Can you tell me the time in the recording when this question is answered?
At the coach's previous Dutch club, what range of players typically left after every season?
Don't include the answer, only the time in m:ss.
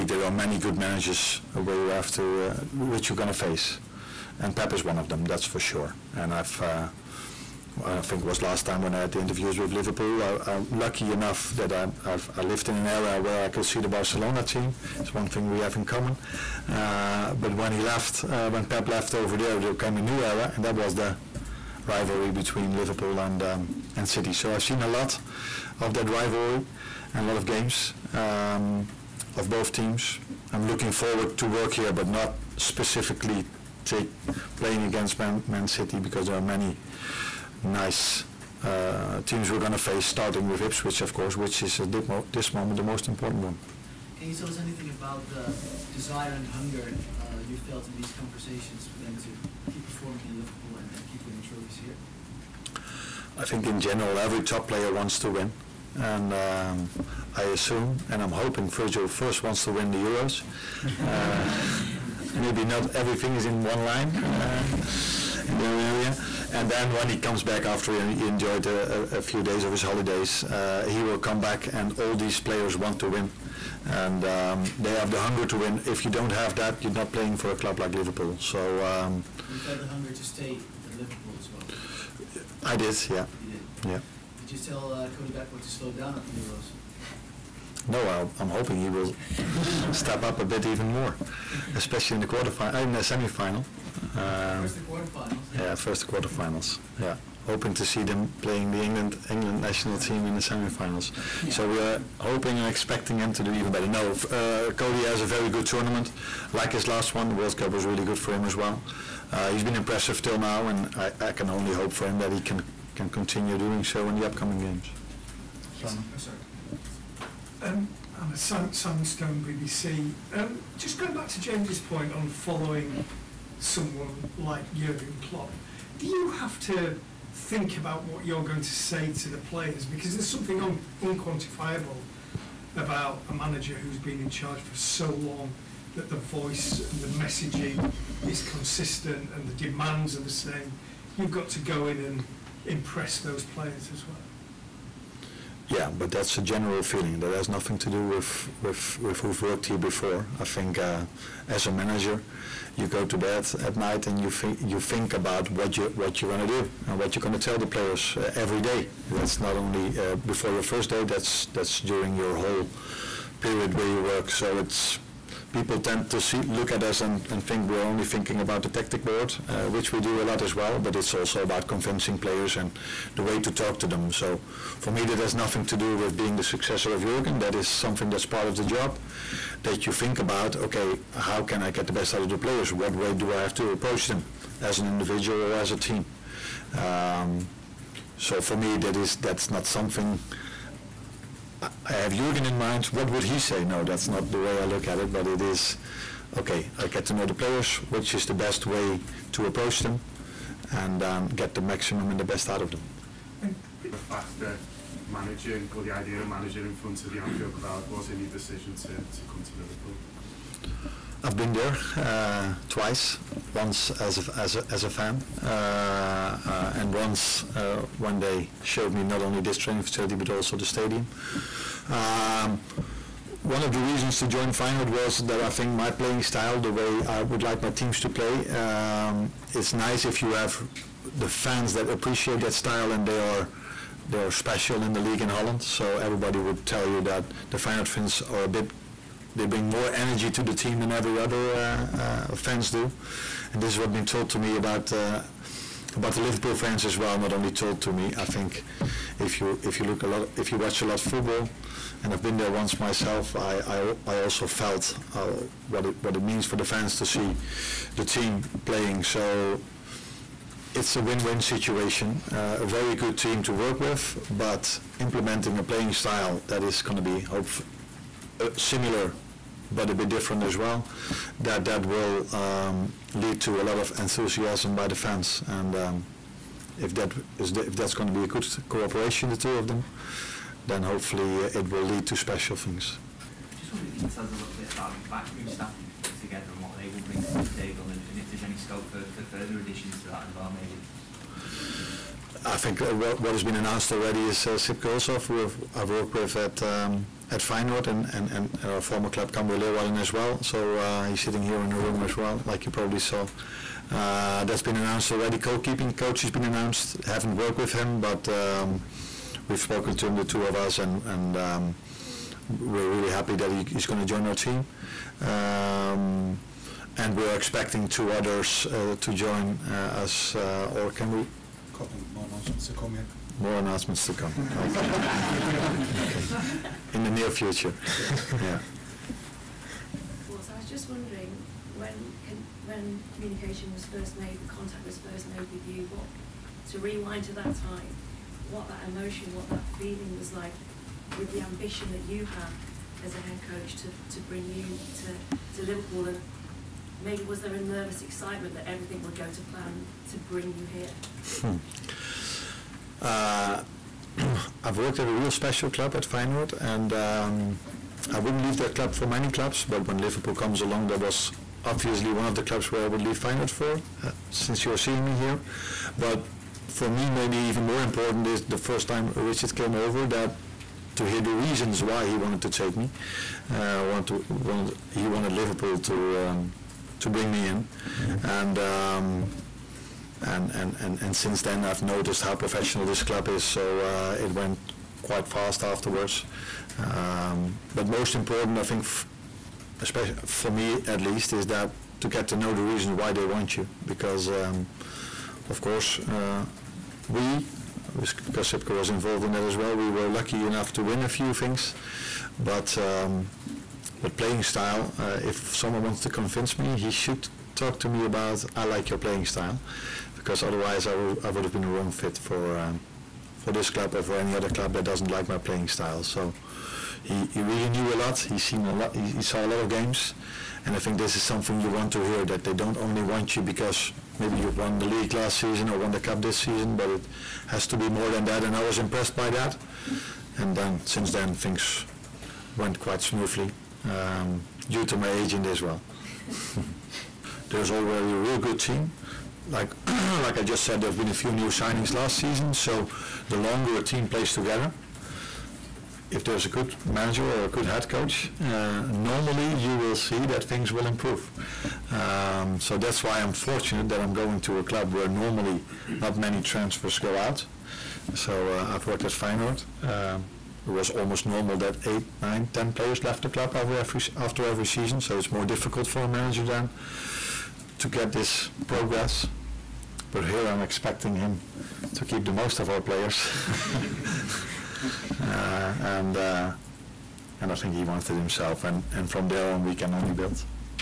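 7:41.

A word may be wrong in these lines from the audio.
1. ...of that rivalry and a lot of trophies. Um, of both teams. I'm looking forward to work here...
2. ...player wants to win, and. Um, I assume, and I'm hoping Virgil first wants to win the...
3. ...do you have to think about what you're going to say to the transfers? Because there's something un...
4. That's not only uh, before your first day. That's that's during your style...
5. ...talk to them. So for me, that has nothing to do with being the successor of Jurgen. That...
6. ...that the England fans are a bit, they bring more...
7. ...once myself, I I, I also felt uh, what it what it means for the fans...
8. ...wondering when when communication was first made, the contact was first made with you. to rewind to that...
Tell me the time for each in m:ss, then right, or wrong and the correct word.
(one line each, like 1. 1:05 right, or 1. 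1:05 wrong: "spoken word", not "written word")
1. 0:25 wrong: "games", not "trophies"
2. 0:54 right
3. 2:05 wrong: "players", not "transfers"
4. 2:39 wrong: "whole", not "style"
5. 2:53 right
6. 3:57 wrong: "Feyenoord", not "England"
7. 4:12 right
8. 5:30 right.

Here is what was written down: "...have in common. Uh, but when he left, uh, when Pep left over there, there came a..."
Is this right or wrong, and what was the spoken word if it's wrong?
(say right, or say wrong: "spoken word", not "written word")
right.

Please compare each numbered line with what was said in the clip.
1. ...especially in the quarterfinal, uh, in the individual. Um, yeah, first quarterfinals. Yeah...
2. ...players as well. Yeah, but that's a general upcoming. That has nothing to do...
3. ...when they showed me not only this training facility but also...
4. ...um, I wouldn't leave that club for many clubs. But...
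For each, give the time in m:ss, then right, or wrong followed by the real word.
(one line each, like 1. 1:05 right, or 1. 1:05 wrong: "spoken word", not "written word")
1. 1:31 wrong: "semifinal", not "individual"
2. 2:23 wrong: "feeling", not "upcoming"
3. 3:37 right
4. 5:56 right.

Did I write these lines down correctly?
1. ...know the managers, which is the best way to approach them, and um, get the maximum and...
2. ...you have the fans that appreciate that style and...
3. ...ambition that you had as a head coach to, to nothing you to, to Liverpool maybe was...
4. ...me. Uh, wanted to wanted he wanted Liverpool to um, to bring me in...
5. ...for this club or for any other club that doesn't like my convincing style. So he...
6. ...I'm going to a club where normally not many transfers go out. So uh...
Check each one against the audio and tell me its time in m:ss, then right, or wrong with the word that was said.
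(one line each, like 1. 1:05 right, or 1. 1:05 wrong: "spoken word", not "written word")
1. 3:17 wrong: "players", not "managers"
2. 3:50 right
3. 5:41 wrong: "bring", not "nothing"
4. 6:12 right
5. 6:53 wrong: "playing", not "convincing"
6. 7:33 right.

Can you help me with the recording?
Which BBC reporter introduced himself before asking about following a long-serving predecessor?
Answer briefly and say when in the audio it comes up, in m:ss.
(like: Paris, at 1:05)
Sam Stone, at 1:58.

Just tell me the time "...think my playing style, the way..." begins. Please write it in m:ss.
3:45.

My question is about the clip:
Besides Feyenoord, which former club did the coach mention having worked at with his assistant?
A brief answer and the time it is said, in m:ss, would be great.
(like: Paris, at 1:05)
Cambuur Leeuwarden, at 4:59.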